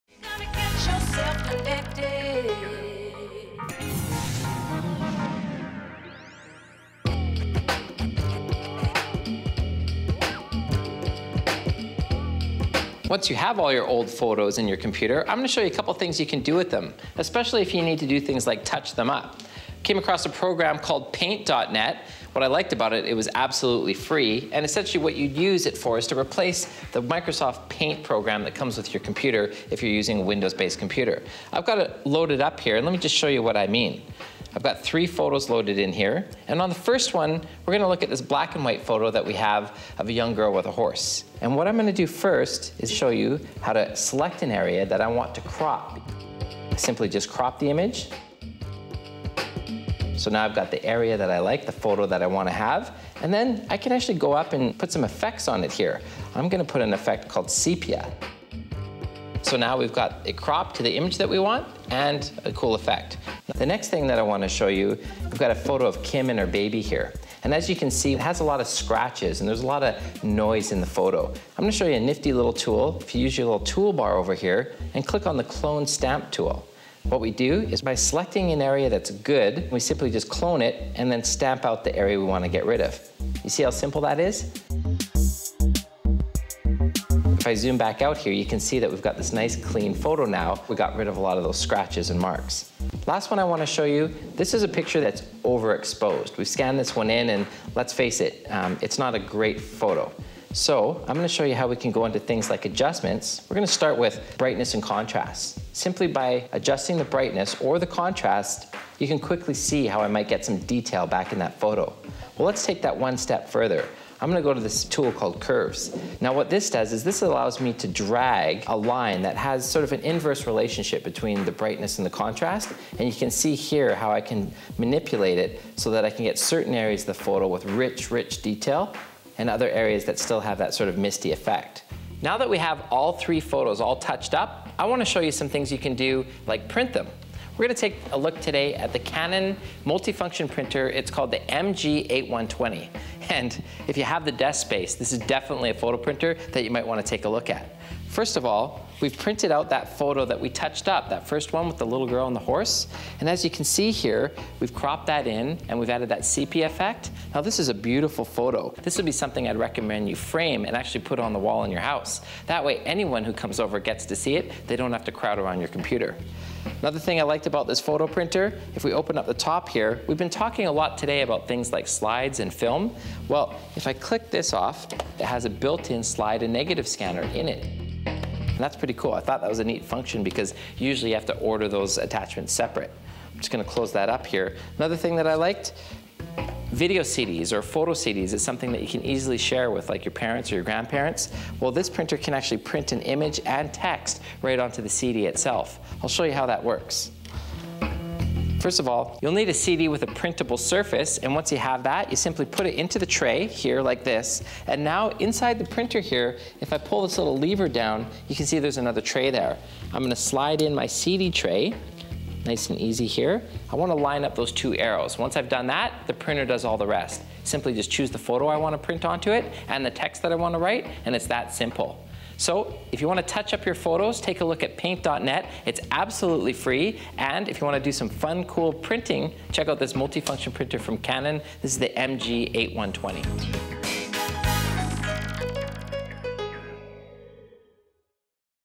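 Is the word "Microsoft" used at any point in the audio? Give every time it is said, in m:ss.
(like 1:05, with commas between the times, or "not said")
0:27.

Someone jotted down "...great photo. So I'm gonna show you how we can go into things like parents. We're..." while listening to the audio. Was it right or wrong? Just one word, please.
wrong.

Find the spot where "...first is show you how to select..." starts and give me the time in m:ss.
0:42.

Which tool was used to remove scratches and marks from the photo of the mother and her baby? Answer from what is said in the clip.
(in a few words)
Clone stamp tool.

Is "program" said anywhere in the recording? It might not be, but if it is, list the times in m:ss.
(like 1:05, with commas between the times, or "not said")
0:20, 0:28.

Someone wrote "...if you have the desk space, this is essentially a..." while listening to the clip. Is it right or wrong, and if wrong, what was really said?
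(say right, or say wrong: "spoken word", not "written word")
wrong: "definitely", not "essentially".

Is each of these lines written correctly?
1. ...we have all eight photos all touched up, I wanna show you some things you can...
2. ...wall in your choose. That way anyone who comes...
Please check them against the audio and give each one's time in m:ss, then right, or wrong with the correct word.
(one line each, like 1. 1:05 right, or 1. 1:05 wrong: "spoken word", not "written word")
1. 2:12 wrong: "three", not "eight"
2. 2:41 wrong: "house", not "choose".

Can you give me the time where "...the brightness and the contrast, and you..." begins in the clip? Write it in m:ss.
2:01.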